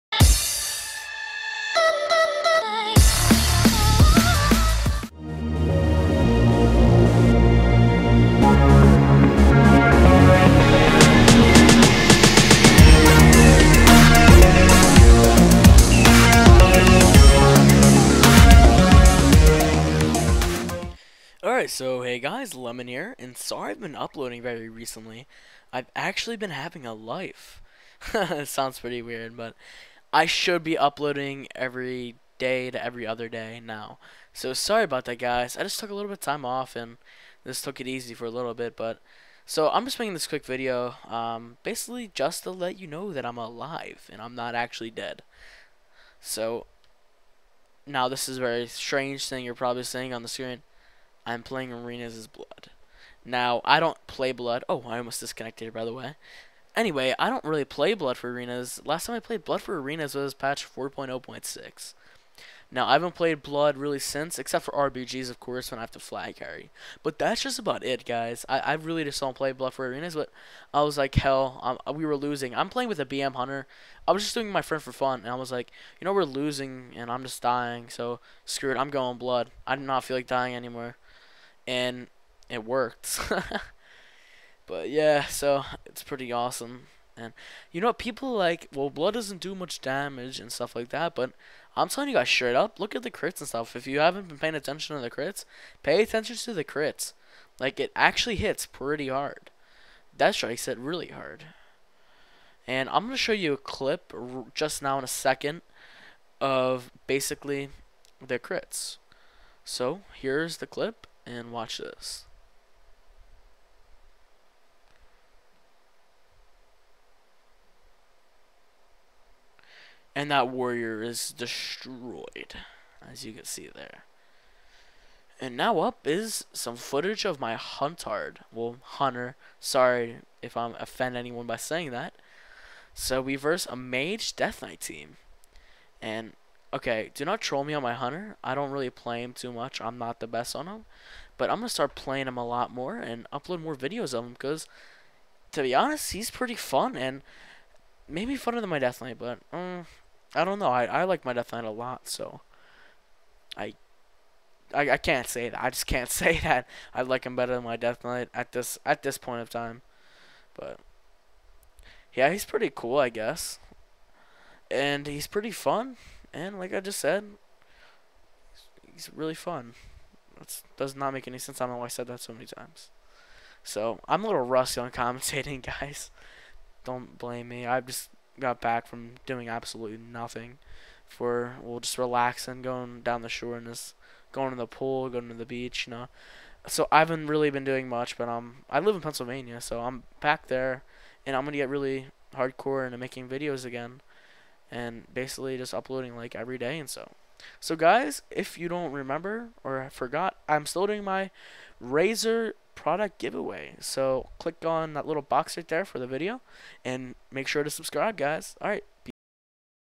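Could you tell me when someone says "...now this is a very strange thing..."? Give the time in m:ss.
0:47.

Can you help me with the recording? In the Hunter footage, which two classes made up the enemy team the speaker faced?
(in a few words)
Mage Death Knight.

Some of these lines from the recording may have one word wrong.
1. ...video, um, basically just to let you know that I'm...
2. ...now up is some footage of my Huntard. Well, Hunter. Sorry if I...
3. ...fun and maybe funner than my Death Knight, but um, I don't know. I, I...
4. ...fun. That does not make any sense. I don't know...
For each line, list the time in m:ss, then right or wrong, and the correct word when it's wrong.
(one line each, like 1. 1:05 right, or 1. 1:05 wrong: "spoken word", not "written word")
1. 0:40 right
2. 2:05 right
3. 2:26 right
4. 2:49 right.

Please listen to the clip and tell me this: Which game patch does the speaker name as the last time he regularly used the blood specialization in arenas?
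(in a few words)
4.0.6.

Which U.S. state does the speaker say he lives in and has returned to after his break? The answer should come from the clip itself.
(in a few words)
Pennsylvania.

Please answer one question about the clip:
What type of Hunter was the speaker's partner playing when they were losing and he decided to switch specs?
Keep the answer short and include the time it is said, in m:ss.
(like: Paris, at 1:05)
BM Hunter, at 1:13.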